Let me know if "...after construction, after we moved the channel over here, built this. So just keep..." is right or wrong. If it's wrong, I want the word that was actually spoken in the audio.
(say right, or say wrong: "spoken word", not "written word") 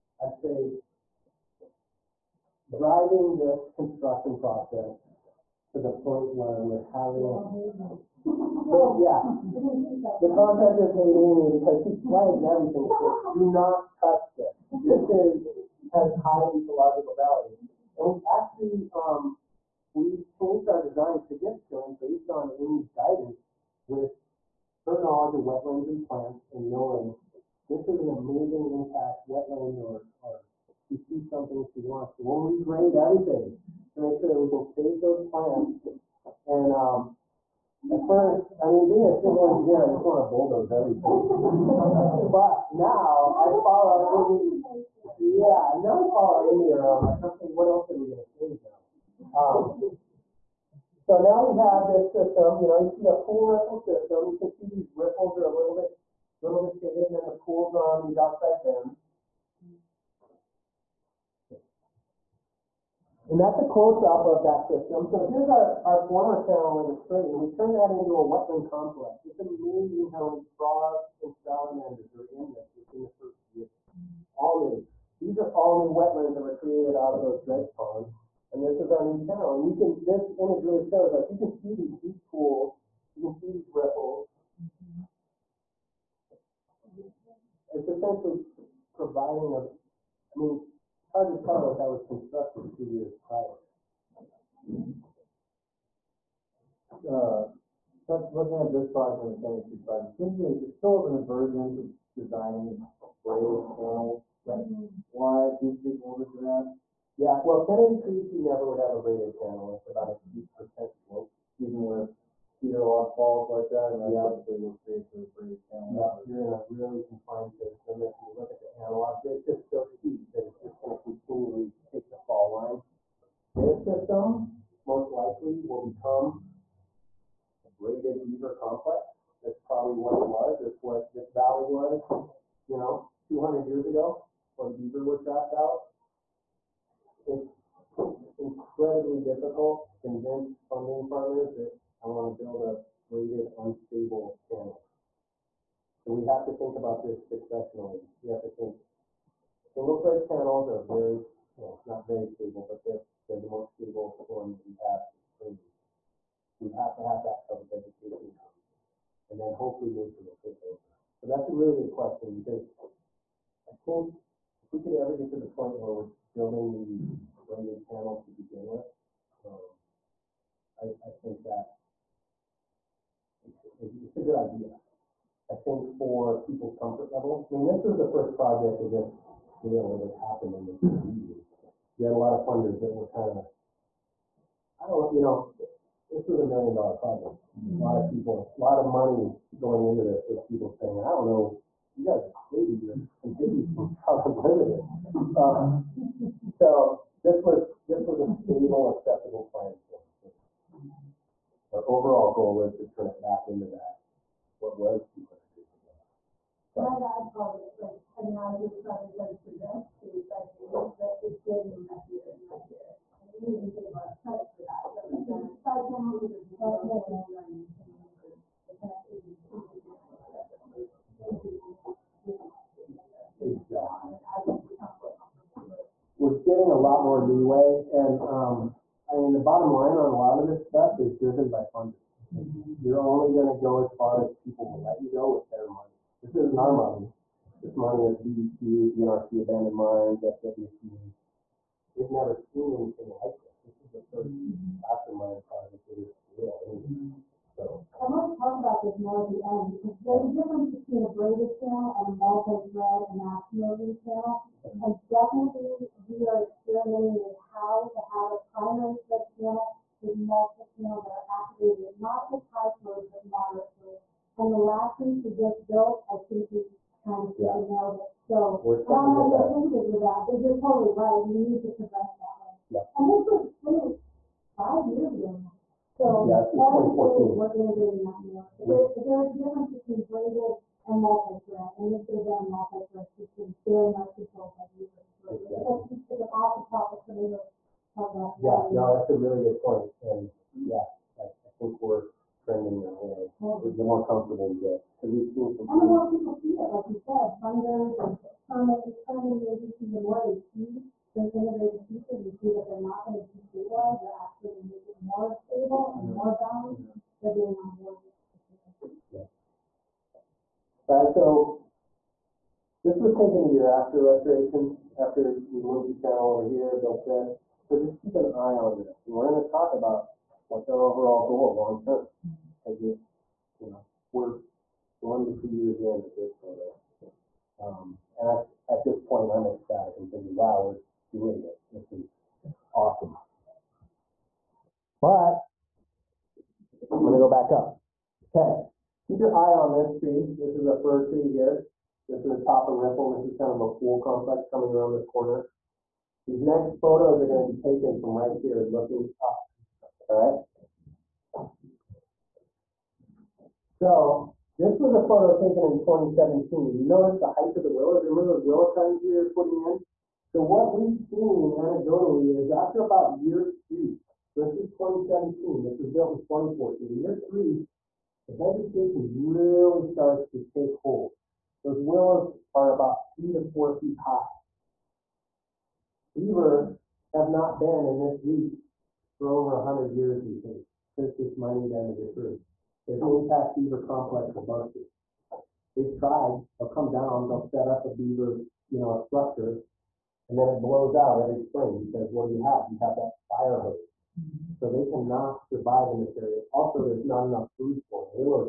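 wrong: "restoration", not "construction".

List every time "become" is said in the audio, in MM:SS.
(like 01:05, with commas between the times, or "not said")
02:05, 03:44.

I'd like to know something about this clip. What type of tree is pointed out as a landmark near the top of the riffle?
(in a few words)
Fir tree.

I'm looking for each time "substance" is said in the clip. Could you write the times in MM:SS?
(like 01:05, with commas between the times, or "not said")
not said.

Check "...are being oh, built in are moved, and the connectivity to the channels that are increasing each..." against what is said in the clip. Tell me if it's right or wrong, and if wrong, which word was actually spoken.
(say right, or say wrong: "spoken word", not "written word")
wrong: "maintained", not "moved".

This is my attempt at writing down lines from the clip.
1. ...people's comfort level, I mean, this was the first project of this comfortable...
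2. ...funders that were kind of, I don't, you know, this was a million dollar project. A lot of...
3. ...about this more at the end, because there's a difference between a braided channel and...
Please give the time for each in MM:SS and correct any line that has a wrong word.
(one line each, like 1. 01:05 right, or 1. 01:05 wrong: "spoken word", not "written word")
1. 02:56 wrong: "scale", not "comfortable"
2. 03:02 right
3. 04:08 right.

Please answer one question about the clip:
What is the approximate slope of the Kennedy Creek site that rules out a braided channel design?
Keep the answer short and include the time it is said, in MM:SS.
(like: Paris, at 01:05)
8 percent, at 01:50.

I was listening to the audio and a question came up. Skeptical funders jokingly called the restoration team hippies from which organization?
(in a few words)
Trout Unlimited.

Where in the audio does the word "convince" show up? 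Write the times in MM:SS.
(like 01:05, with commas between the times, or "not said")
02:20.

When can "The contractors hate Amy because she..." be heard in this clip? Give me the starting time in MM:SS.
00:10.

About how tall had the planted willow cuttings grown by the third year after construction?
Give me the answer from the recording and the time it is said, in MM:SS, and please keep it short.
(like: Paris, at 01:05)
3 to 4 feet, at 06:13.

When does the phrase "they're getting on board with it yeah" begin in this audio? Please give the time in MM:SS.
05:07.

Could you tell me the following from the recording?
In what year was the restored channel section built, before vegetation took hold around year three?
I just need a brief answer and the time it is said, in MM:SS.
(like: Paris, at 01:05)
2014, at 06:06.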